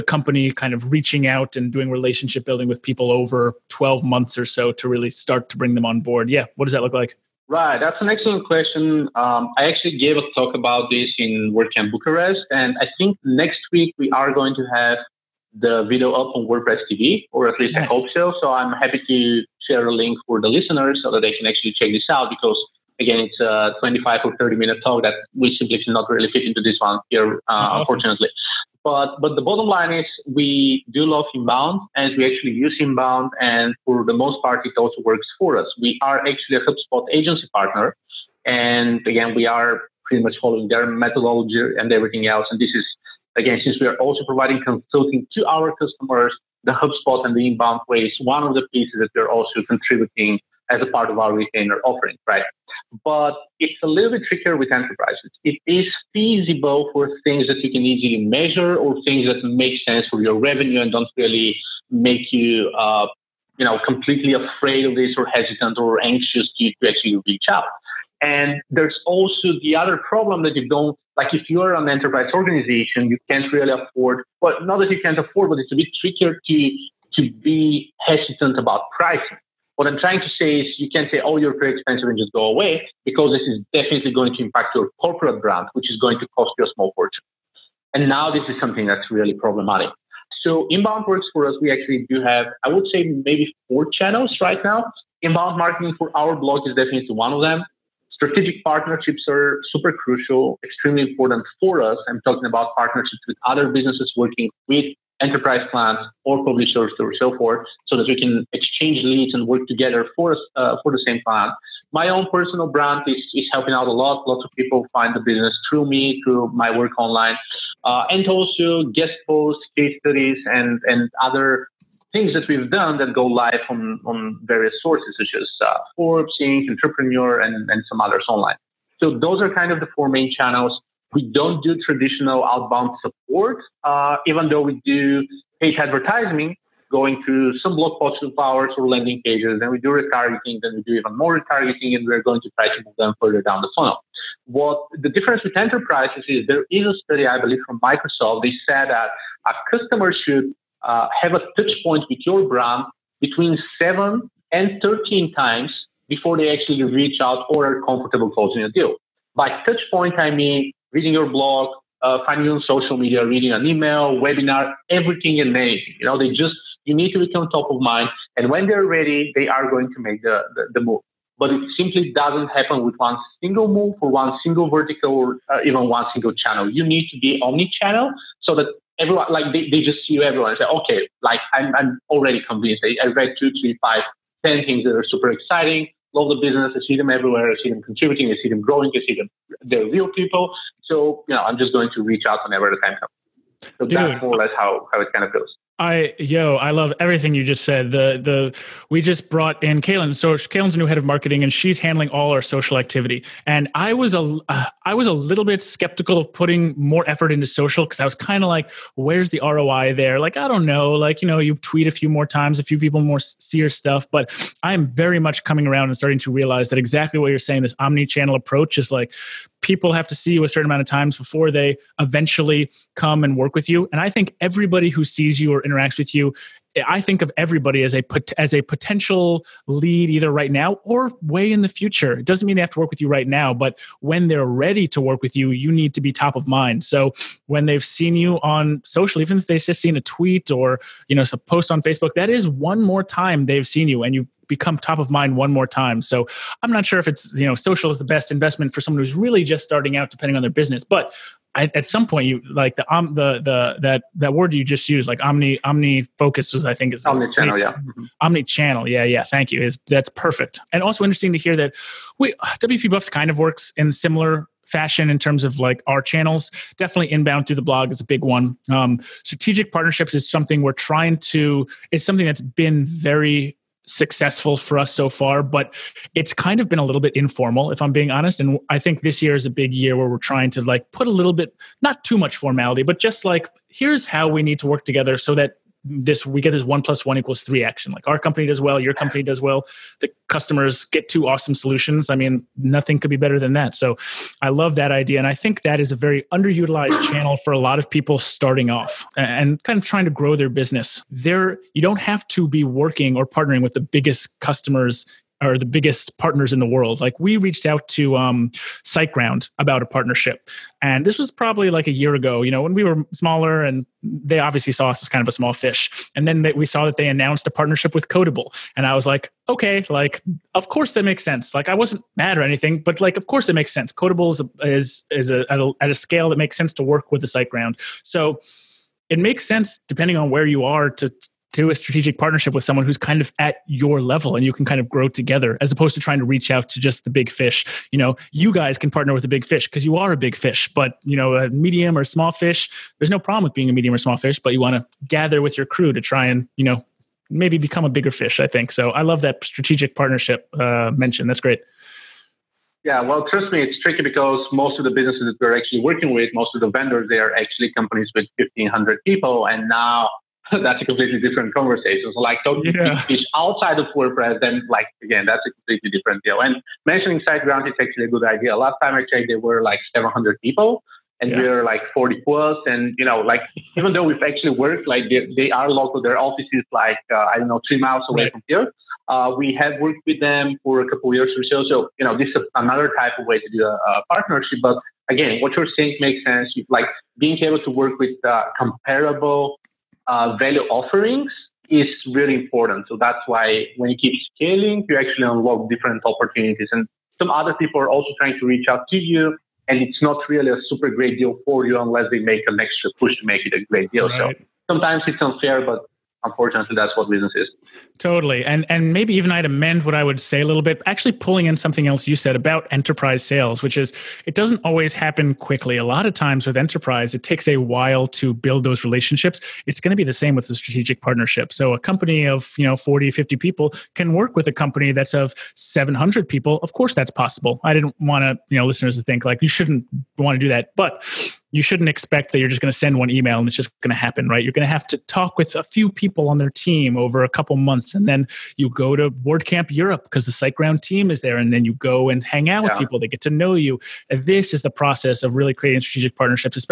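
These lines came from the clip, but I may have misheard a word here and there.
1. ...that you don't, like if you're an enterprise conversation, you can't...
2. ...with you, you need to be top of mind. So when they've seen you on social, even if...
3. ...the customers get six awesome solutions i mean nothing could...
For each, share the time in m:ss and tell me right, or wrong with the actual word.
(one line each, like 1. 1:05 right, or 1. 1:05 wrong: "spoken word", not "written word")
1. 1:10 wrong: "organization", not "conversation"
2. 3:55 right
3. 4:50 wrong: "two", not "six".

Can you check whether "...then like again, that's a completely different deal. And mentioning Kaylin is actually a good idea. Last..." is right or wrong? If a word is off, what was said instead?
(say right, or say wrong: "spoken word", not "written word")
wrong: "SiteGround", not "Kaylin".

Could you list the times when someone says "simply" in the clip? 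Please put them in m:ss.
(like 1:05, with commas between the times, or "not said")
0:25, 2:51.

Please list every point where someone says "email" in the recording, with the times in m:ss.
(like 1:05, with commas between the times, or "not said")
2:43, 7:13.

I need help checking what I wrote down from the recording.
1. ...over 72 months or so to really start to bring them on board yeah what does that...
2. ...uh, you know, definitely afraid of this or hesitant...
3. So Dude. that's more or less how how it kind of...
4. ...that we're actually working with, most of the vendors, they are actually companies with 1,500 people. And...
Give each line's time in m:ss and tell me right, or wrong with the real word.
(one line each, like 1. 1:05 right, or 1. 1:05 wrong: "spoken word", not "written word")
1. 0:03 wrong: "12", not "72"
2. 1:02 wrong: "completely", not "definitely"
3. 3:13 right
4. 5:55 right.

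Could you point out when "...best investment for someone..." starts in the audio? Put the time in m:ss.
4:08.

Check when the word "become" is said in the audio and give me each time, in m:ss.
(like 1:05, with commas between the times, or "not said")
2:47, 4:04, 5:47.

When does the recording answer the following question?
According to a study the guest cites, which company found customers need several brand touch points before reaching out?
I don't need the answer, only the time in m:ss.
2:27.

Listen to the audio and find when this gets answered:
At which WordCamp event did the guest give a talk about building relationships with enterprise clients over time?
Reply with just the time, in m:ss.
0:11.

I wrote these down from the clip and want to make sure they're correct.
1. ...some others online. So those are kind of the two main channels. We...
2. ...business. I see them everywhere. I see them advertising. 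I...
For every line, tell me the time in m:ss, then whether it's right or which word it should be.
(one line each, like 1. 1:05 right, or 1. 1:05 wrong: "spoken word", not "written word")
1. 2:07 wrong: "four", not "two"
2. 3:06 wrong: "contributing", not "advertising".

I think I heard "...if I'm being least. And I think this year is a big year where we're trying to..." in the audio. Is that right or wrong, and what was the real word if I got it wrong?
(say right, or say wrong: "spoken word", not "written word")
wrong: "honest", not "least".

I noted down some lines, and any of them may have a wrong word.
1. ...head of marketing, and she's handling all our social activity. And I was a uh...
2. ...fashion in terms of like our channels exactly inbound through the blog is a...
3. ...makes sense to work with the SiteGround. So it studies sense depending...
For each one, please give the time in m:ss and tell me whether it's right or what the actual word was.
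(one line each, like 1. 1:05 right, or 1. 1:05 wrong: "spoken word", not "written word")
1. 3:20 right
2. 4:24 wrong: "definitely", not "exactly"
3. 5:26 wrong: "makes", not "studies".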